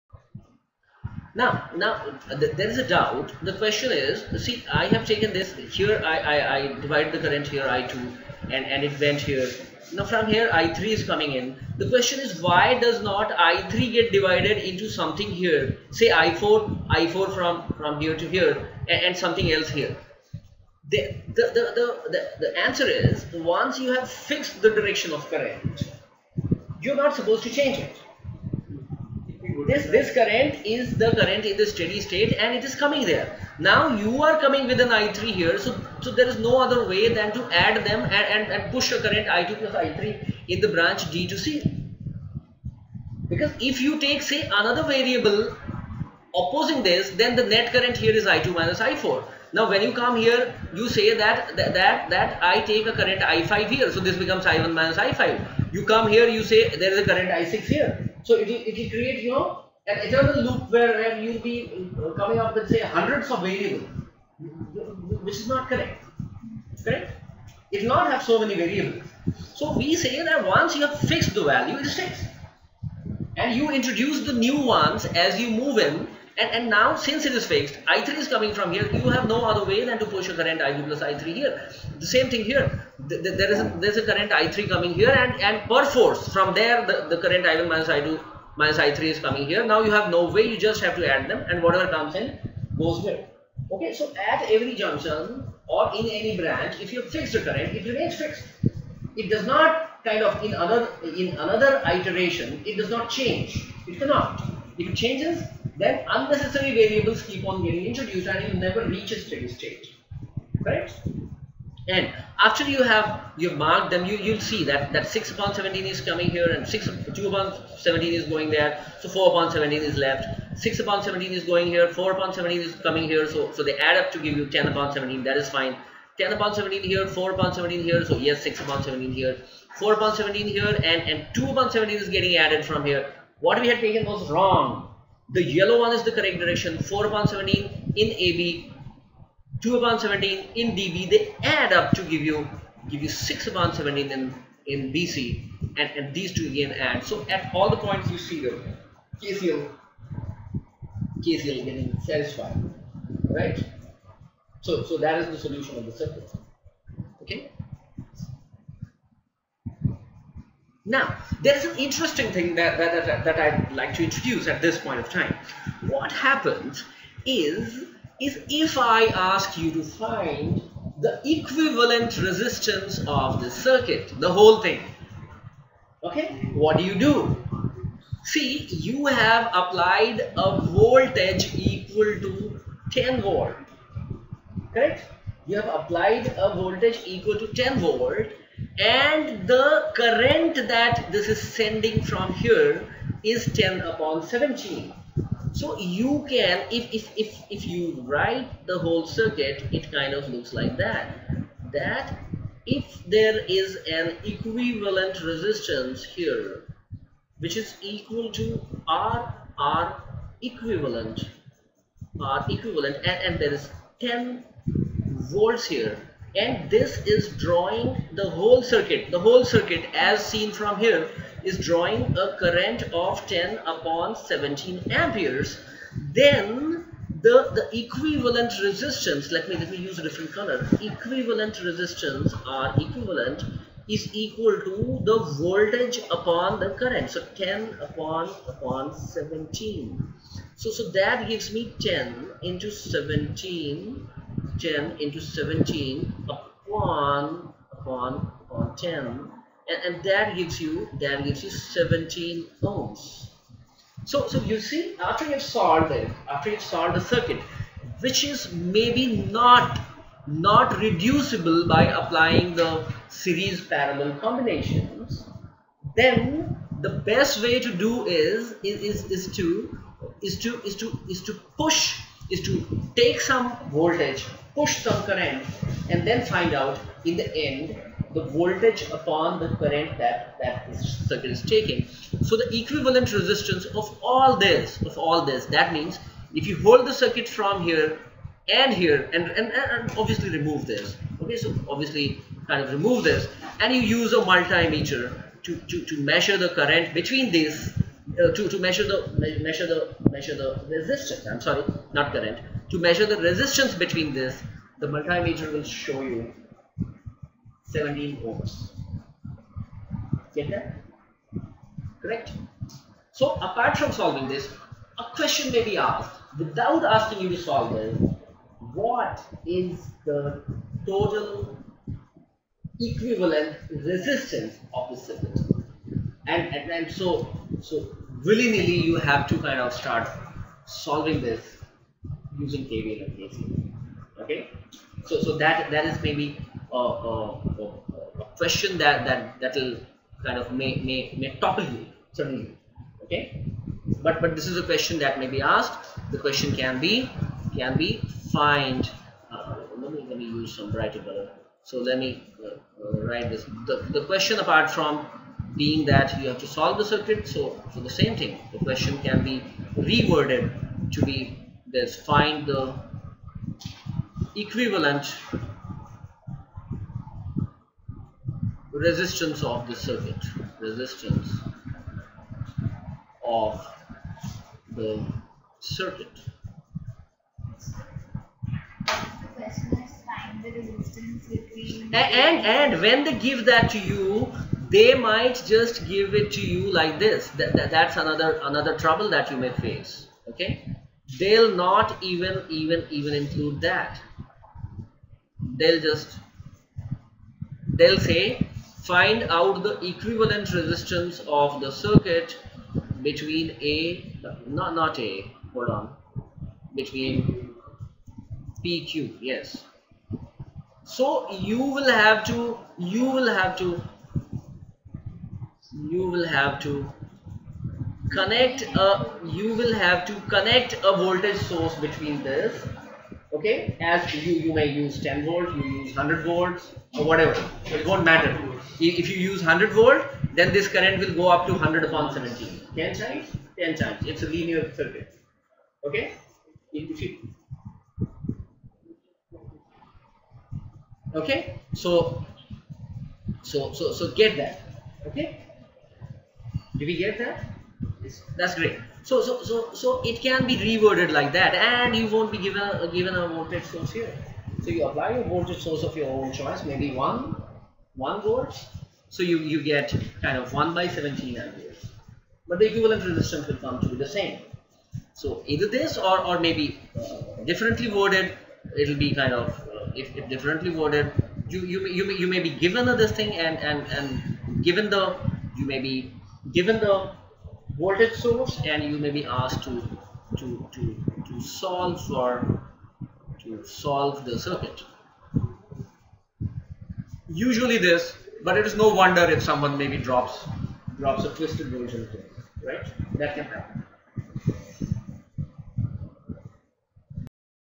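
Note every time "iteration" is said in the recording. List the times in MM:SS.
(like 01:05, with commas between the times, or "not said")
01:41.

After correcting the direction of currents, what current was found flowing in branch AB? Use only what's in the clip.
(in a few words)
4/17.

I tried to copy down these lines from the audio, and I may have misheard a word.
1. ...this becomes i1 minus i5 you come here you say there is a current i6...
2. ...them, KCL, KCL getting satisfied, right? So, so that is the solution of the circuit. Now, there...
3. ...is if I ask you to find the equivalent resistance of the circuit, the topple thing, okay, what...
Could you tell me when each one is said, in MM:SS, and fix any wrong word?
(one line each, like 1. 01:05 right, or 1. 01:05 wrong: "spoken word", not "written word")
1. 00:53 right
2. 02:28 right
3. 02:48 wrong: "whole", not "topple".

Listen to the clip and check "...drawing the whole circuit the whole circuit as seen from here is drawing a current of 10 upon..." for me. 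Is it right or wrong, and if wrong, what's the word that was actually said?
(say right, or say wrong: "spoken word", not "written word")
right.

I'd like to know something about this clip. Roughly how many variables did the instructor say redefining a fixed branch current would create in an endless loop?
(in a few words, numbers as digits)
hundreds.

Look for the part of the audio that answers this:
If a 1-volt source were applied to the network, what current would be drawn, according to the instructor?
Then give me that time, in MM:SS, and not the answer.
07:40.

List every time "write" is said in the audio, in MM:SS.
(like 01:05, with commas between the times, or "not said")
03:18, 05:53.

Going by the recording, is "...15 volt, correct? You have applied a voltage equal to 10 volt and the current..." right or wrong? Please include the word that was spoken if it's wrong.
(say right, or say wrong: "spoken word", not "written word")
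wrong: "10", not "15".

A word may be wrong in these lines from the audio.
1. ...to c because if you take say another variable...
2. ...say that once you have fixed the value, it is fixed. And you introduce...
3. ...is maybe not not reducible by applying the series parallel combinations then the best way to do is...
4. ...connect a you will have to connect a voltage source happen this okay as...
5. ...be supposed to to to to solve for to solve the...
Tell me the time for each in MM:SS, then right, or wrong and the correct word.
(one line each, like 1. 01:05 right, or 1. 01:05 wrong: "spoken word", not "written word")
1. 00:41 right
2. 01:09 right
3. 04:18 right
4. 06:58 wrong: "between", not "happen"
5. 07:59 wrong: "asked", not "supposed".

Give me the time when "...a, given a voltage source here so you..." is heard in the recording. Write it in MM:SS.
07:32.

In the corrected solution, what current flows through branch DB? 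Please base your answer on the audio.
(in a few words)
2/17.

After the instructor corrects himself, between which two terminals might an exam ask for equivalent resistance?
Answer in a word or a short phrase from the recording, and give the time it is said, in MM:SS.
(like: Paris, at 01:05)
PQ, at 06:48.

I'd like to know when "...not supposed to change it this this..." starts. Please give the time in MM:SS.
00:26.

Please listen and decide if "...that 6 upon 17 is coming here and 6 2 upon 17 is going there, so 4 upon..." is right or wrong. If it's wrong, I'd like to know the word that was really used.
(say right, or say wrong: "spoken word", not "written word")
right.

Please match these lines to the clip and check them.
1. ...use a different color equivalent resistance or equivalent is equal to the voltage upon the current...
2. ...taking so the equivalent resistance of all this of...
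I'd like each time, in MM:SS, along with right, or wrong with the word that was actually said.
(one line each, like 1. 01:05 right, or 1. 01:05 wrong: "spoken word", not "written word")
1. 03:49 right
2. 04:41 right.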